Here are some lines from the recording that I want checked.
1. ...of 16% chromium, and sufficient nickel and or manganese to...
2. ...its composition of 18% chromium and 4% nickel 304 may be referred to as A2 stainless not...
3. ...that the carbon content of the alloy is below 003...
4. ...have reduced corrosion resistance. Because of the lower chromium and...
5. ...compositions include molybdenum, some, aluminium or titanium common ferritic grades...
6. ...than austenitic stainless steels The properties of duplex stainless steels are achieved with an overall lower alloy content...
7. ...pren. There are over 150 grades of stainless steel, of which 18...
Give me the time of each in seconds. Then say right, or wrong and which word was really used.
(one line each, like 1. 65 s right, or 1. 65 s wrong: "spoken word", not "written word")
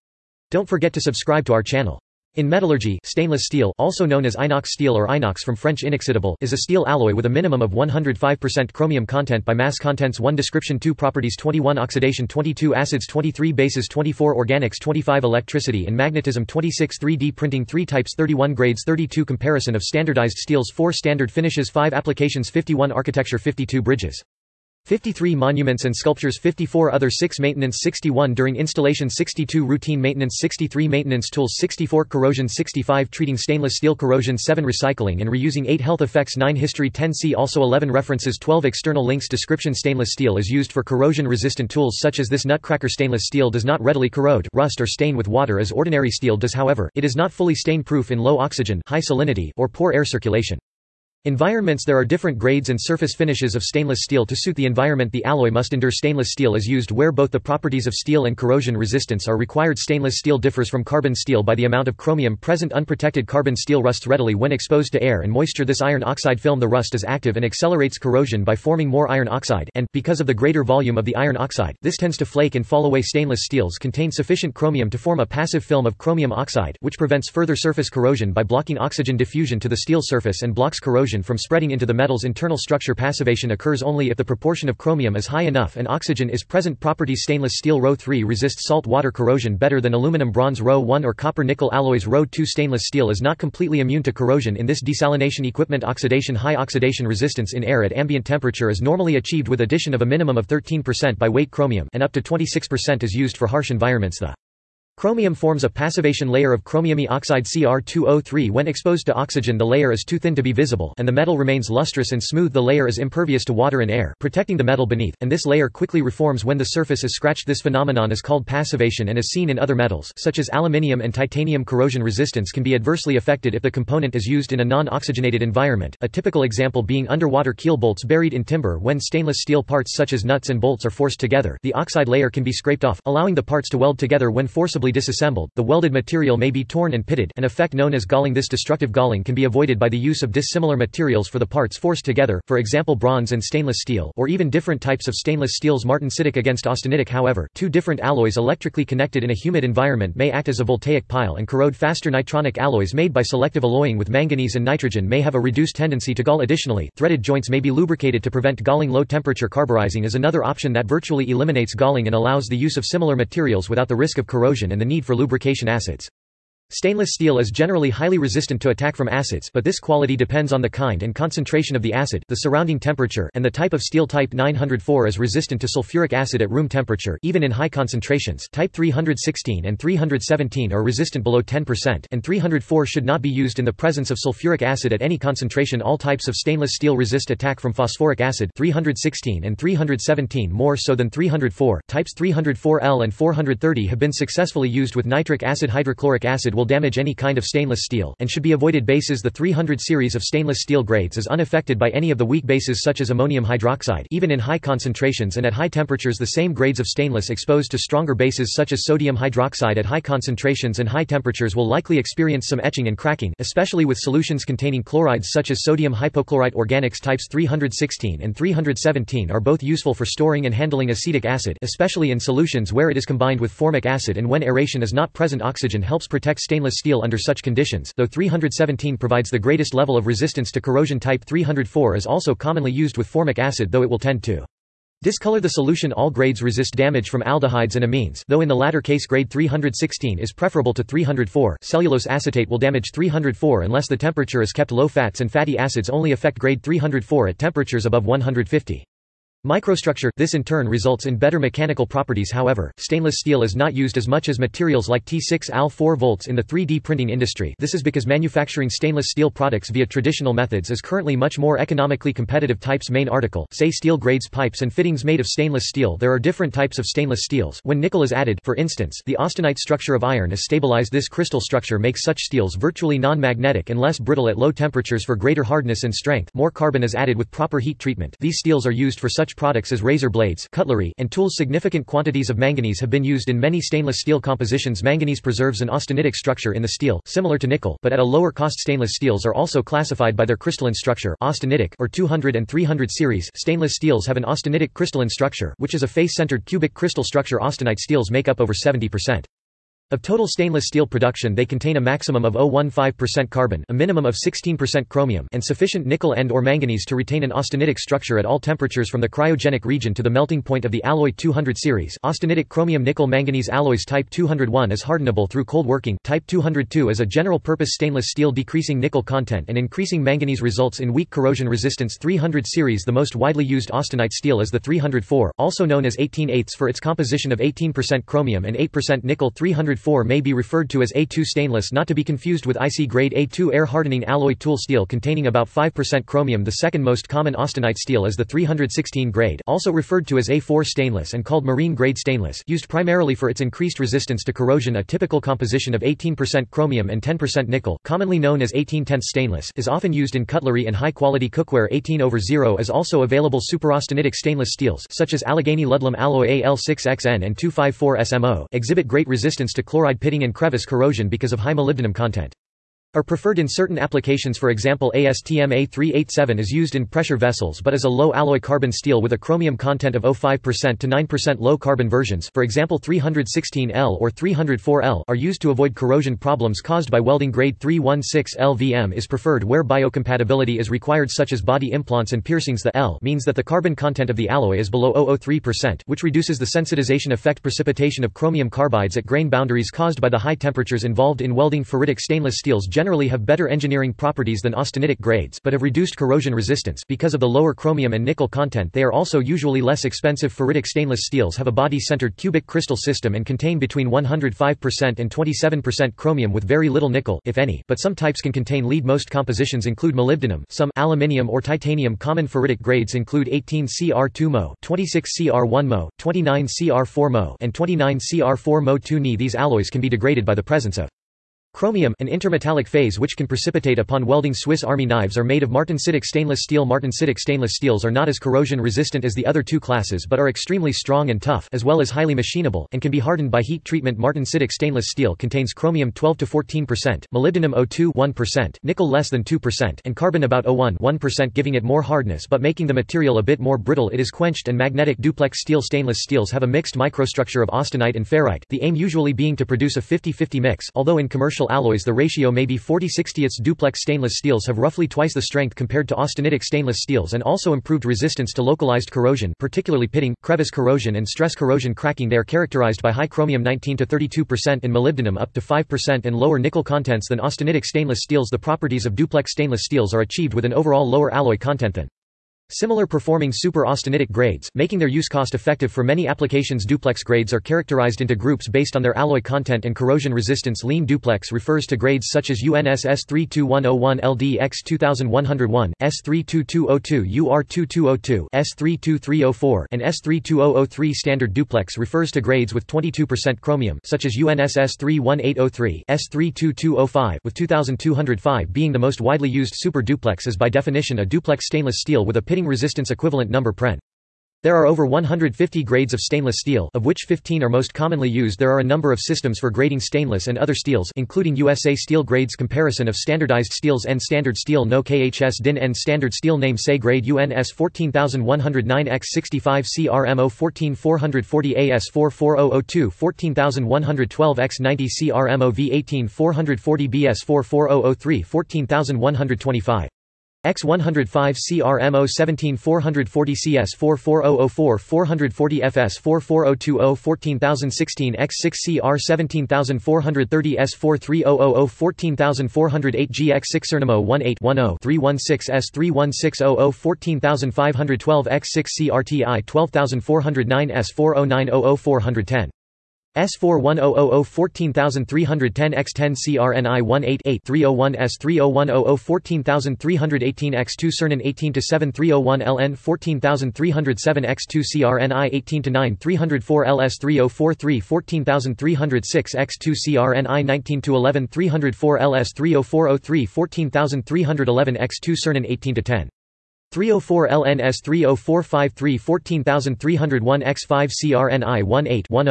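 1. 304 s right
2. 326 s wrong: "8", not "4"
3. 383 s right
4. 395 s right
5. 409 s right
6. 467 s right
7. 503 s wrong: "15", not "18".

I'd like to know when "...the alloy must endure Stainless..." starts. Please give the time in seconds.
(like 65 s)
55 s.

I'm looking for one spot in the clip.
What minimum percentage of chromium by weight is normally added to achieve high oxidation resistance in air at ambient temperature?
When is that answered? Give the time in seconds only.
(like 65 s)
100 s.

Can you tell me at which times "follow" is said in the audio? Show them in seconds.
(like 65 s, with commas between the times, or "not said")
not said.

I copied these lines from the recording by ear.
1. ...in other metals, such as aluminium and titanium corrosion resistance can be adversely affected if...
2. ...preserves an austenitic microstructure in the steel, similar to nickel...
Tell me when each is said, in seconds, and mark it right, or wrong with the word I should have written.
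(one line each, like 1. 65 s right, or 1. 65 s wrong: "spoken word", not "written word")
1. 119 s right
2. 285 s wrong: "structure", not "microstructure".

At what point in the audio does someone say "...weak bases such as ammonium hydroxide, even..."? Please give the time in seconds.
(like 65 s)
202 s.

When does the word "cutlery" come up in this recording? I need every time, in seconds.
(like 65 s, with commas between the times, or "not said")
280 s, 350 s.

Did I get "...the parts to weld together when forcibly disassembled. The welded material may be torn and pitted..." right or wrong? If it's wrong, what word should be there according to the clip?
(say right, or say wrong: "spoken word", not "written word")
right.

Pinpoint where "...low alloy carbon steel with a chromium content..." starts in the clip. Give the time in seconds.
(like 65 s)
367 s.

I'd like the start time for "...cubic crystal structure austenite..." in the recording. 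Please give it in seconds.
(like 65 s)
296 s.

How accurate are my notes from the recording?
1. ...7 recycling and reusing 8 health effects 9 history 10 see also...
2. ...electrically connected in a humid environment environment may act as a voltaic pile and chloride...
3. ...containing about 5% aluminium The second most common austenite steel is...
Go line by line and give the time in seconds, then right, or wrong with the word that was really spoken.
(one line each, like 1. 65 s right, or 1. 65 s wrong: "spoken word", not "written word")
1. 34 s right
2. 148 s wrong: "corrode", not "chloride"
3. 334 s wrong: "chromium", not "aluminium".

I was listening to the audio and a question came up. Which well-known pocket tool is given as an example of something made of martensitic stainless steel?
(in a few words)
Swiss army knives.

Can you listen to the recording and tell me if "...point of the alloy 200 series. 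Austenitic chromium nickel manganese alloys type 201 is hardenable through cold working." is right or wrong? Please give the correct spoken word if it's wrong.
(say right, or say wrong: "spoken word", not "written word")
right.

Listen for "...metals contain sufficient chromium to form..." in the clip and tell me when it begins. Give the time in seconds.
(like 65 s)
73 s.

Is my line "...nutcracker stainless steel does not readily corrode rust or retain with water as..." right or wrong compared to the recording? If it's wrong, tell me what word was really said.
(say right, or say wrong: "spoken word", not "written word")
wrong: "stain", not "retain".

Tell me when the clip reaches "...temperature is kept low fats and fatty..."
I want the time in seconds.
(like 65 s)
243 s.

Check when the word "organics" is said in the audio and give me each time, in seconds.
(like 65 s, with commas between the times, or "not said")
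14 s, 216 s.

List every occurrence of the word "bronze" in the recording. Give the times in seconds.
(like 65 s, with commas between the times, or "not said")
90 s, 142 s.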